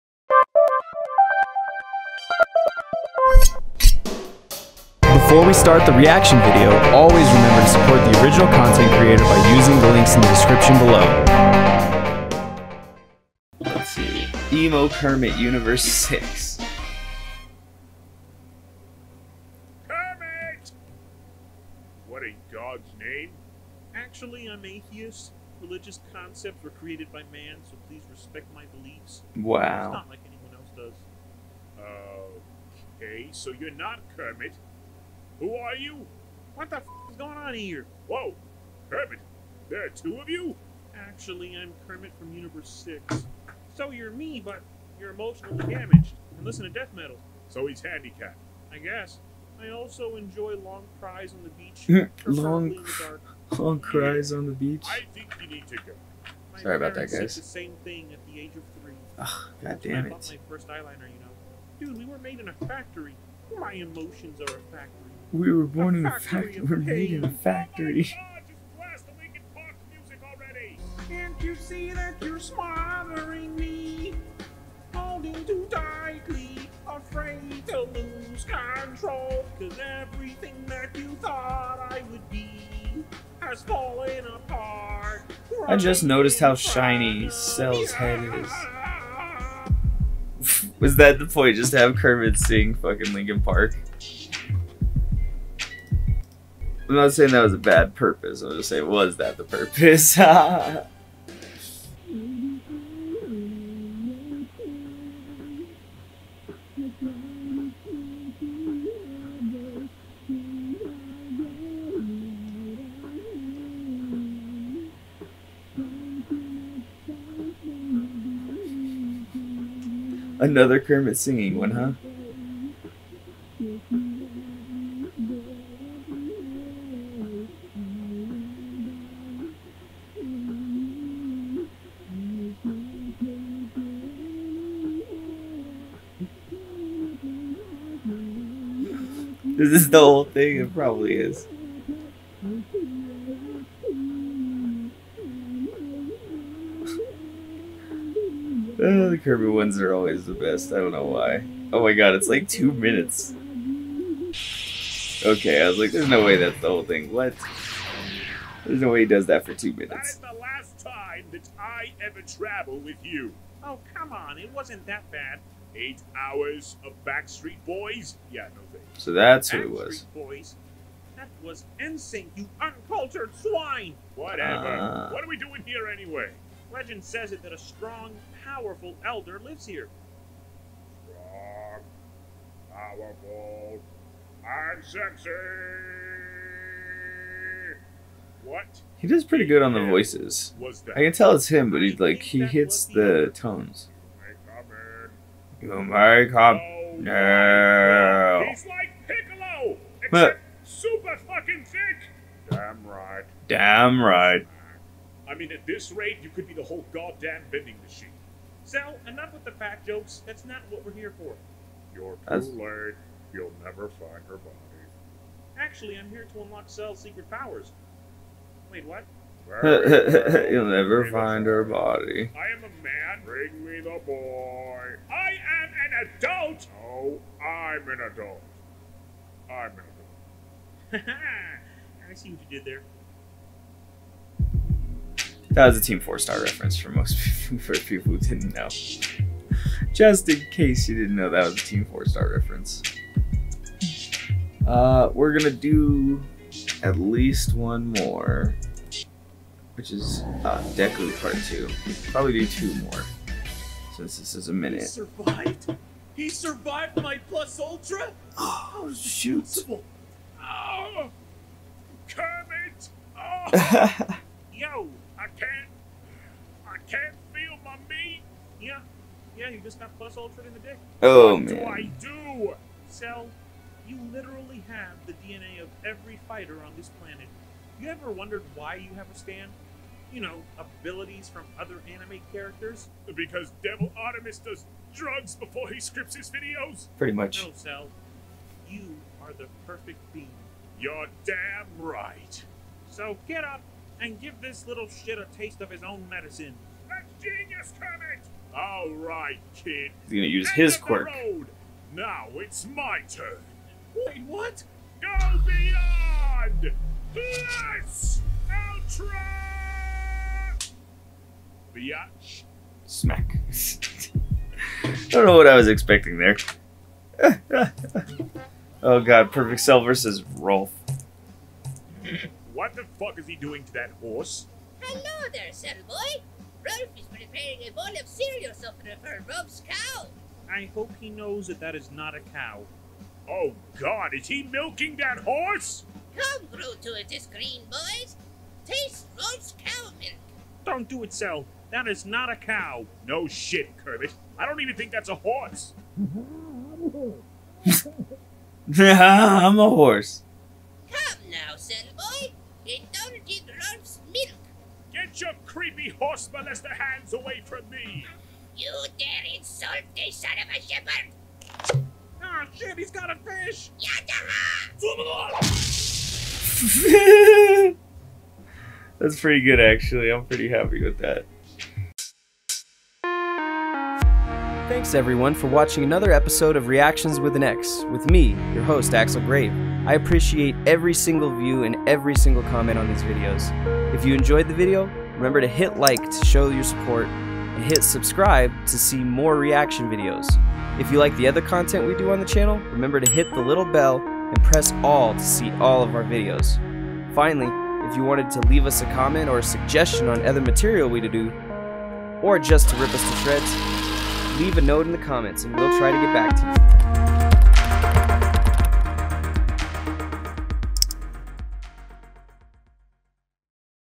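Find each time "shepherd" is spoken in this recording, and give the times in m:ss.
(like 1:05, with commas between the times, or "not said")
6:00.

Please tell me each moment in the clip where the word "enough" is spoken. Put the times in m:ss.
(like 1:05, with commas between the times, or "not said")
3:29.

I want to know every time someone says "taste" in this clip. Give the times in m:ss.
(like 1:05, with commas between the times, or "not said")
4:55, 5:38.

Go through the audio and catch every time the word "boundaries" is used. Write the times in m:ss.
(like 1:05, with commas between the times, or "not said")
not said.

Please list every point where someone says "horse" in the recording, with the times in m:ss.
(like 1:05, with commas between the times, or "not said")
5:24, 5:35, 5:45, 5:49, 5:55.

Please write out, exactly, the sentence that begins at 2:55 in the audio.
What are we doing here anyway?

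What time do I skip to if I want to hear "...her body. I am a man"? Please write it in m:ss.
3:41.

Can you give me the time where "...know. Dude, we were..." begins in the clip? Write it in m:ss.
1:01.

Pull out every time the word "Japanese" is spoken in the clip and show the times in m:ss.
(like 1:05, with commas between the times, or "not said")
not said.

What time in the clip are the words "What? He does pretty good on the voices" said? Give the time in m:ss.
3:08.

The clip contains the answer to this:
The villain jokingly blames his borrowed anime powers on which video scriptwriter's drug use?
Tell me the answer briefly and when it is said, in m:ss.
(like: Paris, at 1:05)
Devil Artemis, at 4:43.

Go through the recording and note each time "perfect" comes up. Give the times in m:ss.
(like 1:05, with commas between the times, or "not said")
4:49, 5:19.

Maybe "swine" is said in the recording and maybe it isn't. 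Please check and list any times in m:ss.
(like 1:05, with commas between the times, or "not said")
2:53.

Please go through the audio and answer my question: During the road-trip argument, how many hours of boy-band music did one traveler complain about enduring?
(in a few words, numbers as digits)
8.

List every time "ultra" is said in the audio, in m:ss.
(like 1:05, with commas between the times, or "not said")
4:17, 4:30, 5:08.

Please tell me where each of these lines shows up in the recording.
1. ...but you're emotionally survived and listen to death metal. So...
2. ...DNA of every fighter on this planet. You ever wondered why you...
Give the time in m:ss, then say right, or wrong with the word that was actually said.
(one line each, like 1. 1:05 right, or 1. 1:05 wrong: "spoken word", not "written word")
1. 0:44 wrong: "damaged", not "survived"
2. 4:35 right.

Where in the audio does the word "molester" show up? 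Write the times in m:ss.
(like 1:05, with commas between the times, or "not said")
5:56.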